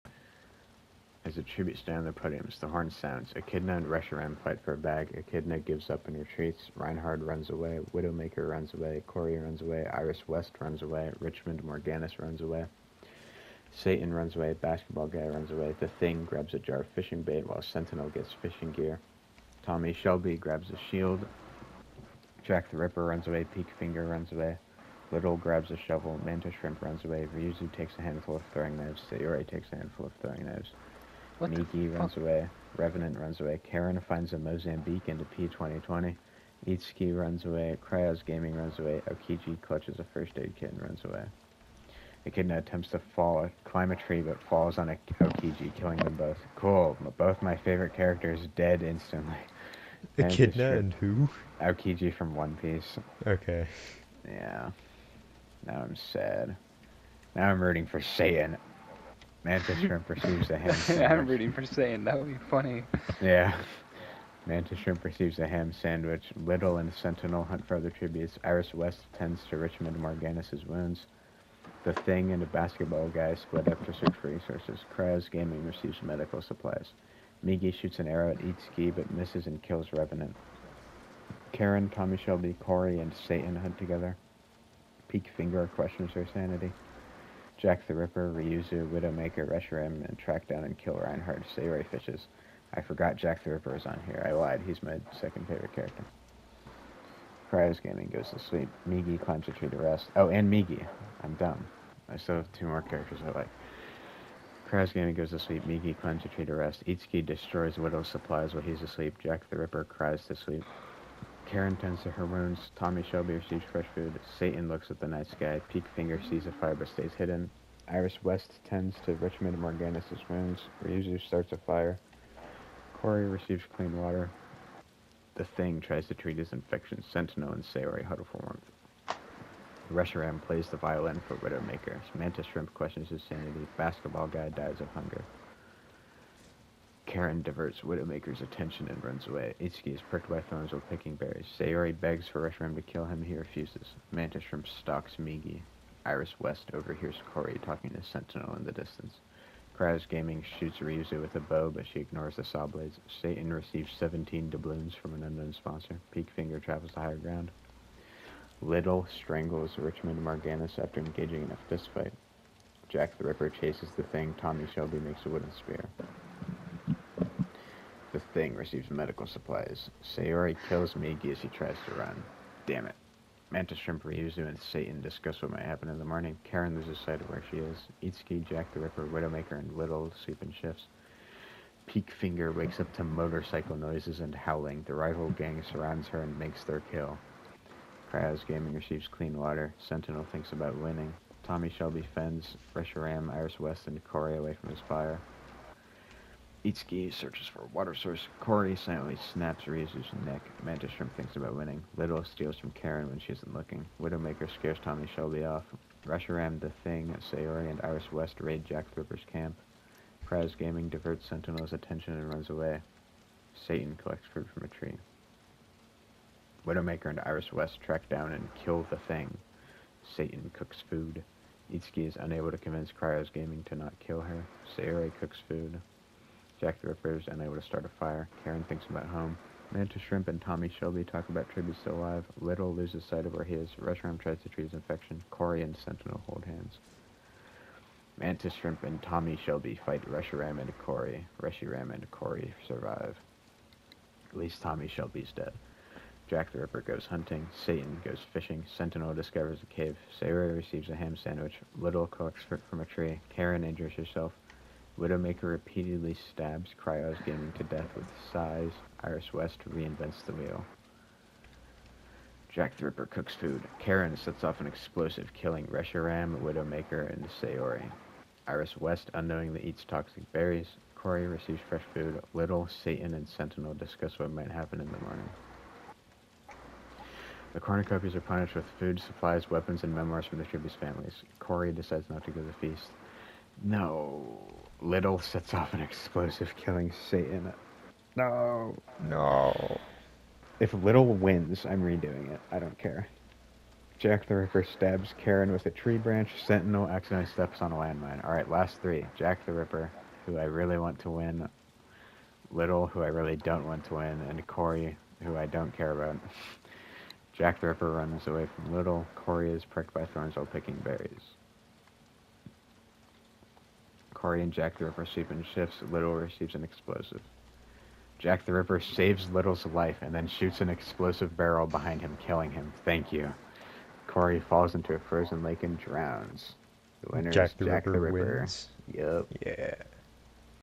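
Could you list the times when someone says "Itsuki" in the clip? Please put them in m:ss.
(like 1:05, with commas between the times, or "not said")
0:36, 1:18, 1:46, 2:19, 2:58, 3:16, 3:41.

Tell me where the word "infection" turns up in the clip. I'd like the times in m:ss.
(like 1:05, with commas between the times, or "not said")
2:06, 3:54.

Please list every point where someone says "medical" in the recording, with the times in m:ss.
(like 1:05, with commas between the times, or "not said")
1:16, 2:48.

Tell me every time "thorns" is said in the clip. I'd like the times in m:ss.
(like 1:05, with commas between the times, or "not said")
2:20, 5:10.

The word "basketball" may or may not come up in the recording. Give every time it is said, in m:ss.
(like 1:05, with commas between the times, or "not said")
0:14, 1:12, 2:13.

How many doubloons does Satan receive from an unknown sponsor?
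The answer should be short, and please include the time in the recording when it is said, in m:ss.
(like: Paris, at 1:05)
17, at 2:33.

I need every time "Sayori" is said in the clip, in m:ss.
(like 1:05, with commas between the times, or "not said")
0:29, 2:07, 2:21, 2:50, 3:27, 3:44, 4:27.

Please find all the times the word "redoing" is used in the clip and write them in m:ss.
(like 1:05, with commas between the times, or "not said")
4:51.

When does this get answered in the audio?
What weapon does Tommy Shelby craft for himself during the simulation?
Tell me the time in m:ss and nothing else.
2:45.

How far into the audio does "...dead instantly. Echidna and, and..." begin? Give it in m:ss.
0:48.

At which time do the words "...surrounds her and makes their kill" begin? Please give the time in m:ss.
3:05.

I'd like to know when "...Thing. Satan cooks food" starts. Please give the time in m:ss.
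3:39.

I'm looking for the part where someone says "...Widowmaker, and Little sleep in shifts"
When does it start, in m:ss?
2:59.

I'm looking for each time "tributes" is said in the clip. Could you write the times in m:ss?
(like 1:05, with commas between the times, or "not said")
0:01, 1:07, 3:51, 4:40.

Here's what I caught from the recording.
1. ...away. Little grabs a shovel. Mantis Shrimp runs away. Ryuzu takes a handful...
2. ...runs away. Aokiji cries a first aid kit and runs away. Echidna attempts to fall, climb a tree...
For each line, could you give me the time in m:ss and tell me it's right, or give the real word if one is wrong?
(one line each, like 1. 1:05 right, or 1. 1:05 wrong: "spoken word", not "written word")
1. 0:24 right
2. 0:38 wrong: "clutches", not "cries".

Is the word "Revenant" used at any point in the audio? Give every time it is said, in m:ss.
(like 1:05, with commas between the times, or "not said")
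0:32, 1:19.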